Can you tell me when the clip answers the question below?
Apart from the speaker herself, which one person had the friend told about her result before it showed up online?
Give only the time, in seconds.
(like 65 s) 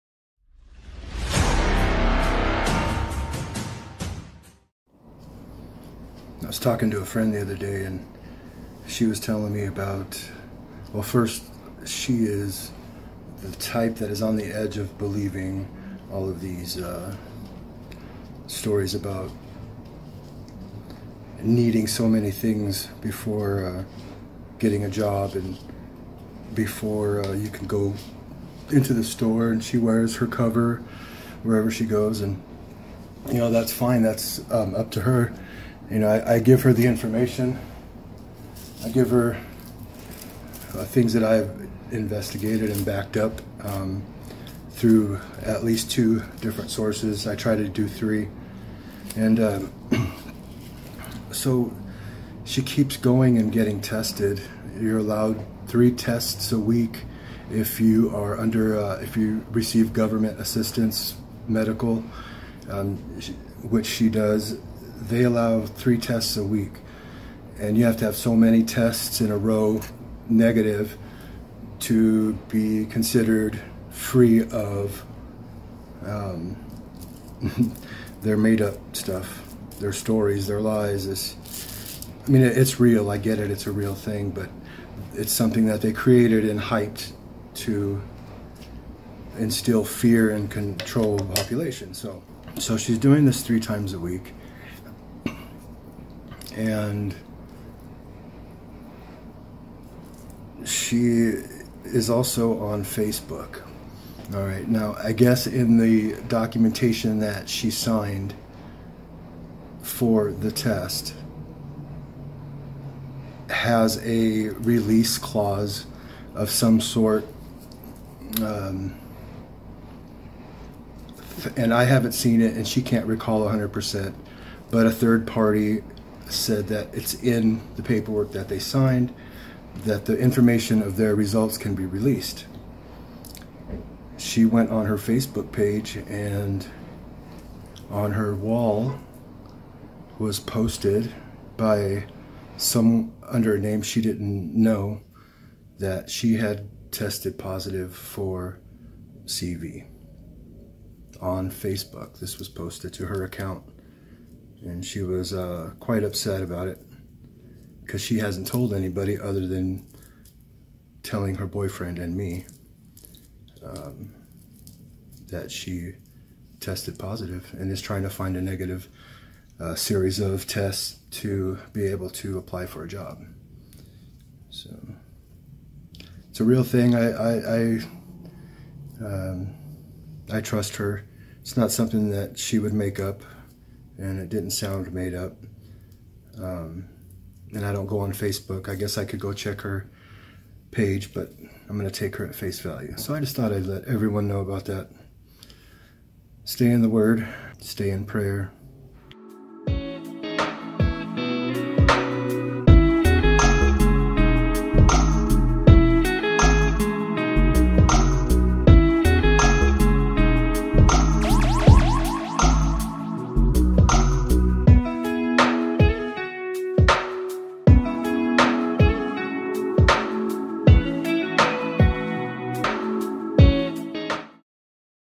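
161 s.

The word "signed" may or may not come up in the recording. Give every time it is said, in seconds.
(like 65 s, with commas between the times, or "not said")
107 s, 128 s.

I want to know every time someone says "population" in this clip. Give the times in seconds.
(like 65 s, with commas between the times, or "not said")
91 s.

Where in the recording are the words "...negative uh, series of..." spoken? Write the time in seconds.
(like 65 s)
168 s.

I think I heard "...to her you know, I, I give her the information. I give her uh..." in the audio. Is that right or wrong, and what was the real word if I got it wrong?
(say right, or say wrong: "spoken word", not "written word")
right.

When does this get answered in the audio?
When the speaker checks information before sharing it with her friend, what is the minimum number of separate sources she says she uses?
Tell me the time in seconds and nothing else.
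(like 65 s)
45 s.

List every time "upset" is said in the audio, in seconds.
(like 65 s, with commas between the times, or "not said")
156 s.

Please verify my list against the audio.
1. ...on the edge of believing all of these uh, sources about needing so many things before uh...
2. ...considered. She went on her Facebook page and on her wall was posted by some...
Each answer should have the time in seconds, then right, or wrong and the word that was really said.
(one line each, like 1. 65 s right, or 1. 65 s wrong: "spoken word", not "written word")
1. 14 s wrong: "stories", not "sources"
2. 131 s wrong: "released", not "considered".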